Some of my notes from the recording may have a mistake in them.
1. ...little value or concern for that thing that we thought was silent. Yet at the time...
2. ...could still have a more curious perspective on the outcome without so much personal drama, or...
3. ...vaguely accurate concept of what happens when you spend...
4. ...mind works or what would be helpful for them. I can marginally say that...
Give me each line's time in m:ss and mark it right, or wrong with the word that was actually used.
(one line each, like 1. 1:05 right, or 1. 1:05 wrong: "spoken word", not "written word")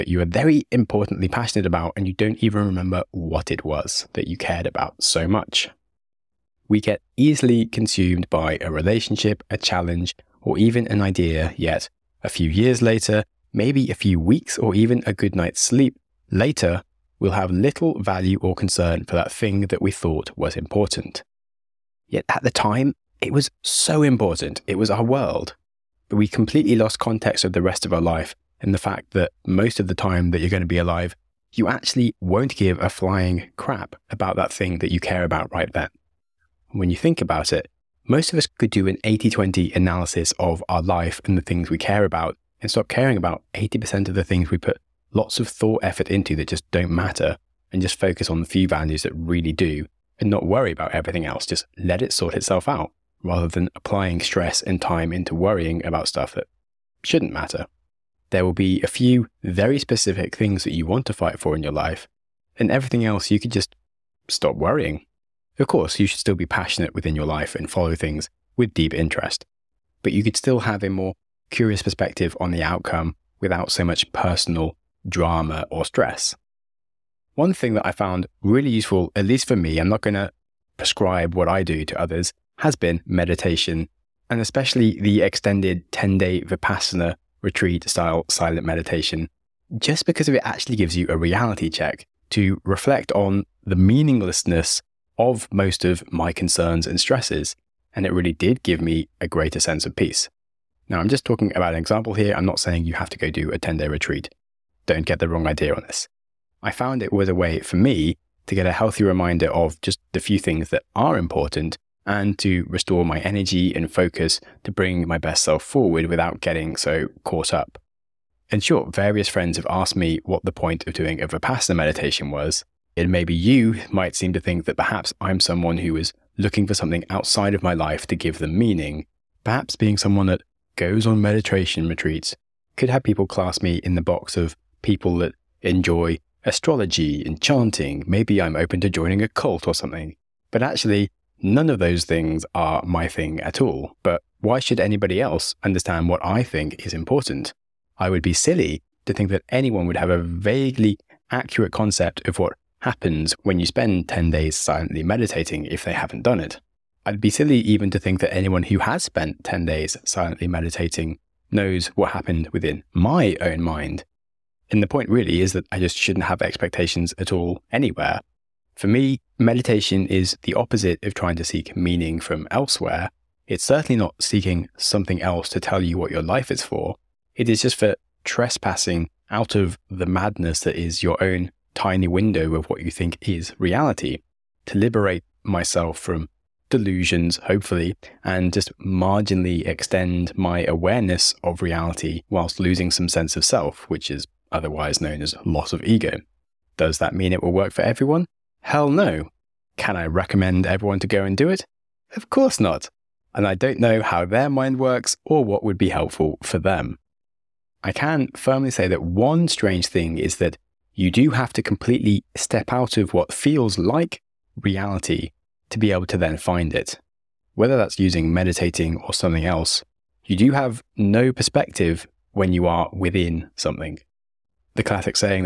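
1. 0:17 wrong: "important", not "silent"
2. 1:10 right
3. 2:30 right
4. 3:24 wrong: "firmly", not "marginally".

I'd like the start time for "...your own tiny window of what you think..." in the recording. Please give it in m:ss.
3:01.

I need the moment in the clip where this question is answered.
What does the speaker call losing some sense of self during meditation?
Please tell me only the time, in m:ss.
3:15.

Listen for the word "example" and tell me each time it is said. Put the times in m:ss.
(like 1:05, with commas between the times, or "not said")
1:41.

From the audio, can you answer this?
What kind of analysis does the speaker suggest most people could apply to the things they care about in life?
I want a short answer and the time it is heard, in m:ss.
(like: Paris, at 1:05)
80 20 analysis, at 0:39.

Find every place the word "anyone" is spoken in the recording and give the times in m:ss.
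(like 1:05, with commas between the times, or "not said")
2:29, 2:38.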